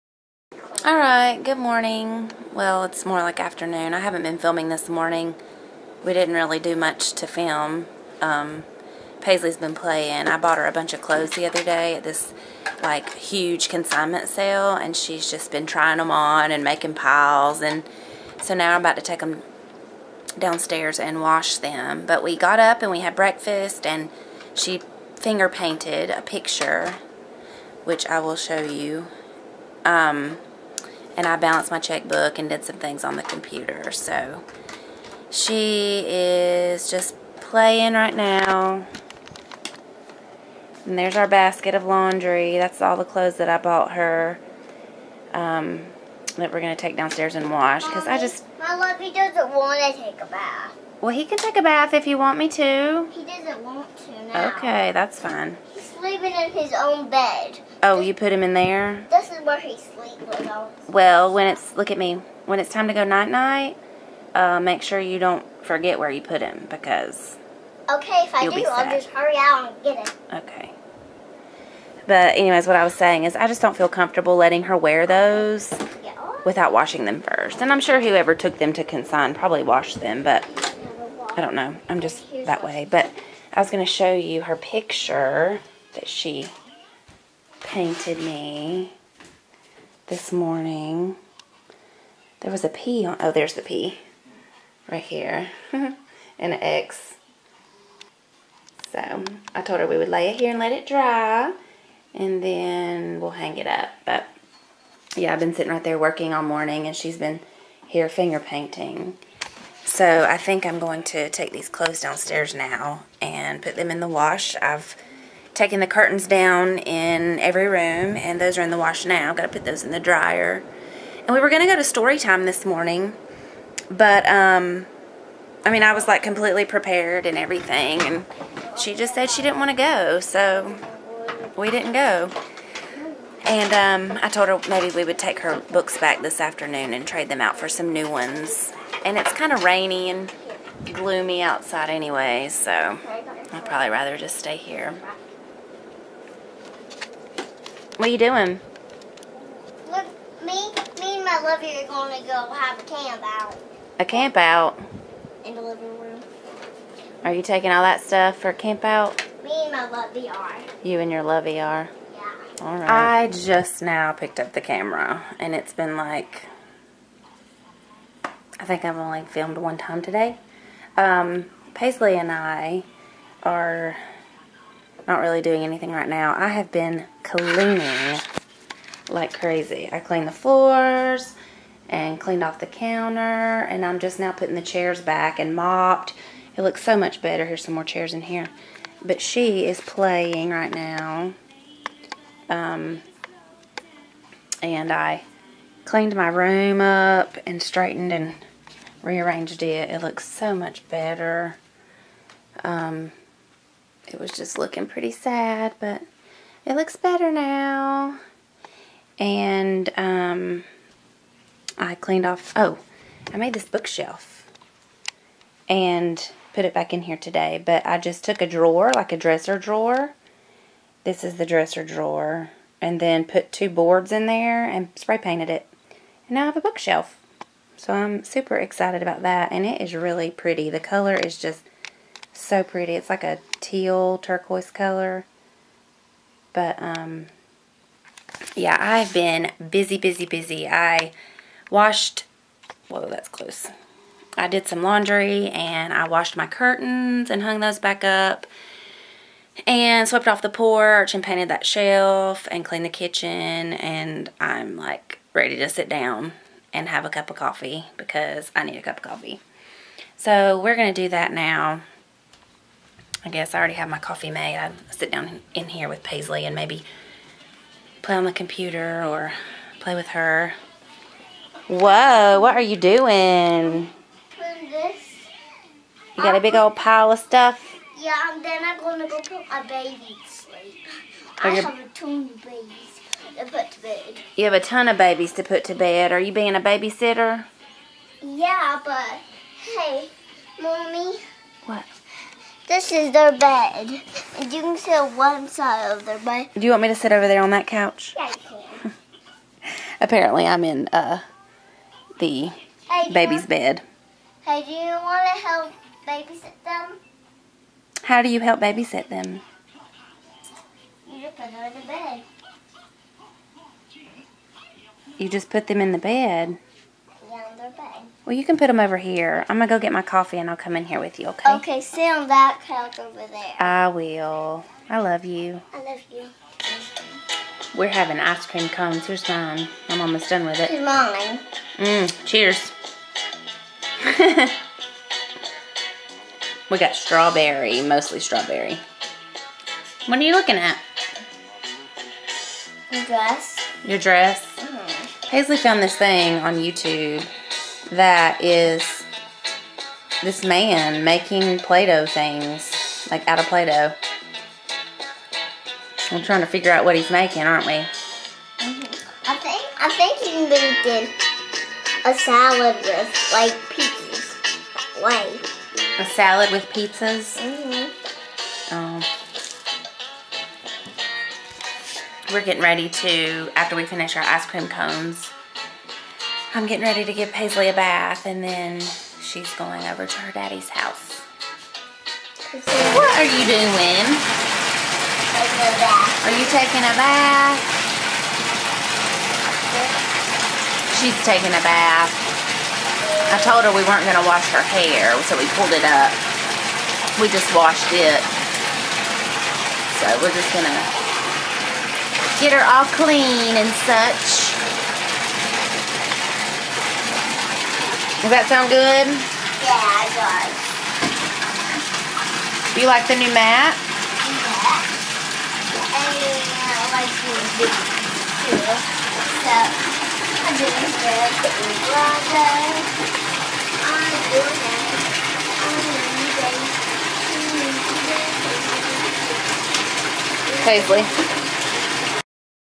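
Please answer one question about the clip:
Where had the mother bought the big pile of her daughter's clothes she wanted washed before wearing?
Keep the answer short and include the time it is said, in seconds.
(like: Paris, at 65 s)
Consignment sale, at 13 s.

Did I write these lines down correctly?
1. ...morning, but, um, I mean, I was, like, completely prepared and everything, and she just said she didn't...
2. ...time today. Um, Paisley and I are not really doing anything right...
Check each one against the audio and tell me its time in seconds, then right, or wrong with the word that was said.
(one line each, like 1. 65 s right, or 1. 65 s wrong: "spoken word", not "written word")
1. 122 s right
2. 169 s right.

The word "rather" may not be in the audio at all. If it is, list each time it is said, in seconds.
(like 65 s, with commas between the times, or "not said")
143 s.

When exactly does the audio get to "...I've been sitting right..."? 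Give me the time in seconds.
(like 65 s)
105 s.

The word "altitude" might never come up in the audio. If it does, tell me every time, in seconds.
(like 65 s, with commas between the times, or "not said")
not said.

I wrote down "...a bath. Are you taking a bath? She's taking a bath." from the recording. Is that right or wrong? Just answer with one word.
right.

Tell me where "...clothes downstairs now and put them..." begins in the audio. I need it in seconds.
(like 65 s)
111 s.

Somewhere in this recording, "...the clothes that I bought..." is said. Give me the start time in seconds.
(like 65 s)
42 s.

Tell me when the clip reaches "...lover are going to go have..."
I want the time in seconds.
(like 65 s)
151 s.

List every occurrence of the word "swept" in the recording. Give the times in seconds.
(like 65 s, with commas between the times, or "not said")
250 s.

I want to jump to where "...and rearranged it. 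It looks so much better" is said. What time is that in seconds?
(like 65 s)
198 s.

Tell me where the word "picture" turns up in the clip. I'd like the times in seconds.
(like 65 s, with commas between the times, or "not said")
26 s, 84 s.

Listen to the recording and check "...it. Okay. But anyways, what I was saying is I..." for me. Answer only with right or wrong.
right.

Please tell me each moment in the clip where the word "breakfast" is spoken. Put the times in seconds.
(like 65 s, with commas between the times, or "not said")
23 s.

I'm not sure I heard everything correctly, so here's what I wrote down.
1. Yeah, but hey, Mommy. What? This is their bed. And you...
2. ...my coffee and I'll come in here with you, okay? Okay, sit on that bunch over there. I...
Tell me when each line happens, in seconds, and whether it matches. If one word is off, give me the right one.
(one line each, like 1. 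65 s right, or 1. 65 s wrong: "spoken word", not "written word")
1. 288 s right
2. 319 s wrong: "couch", not "bunch".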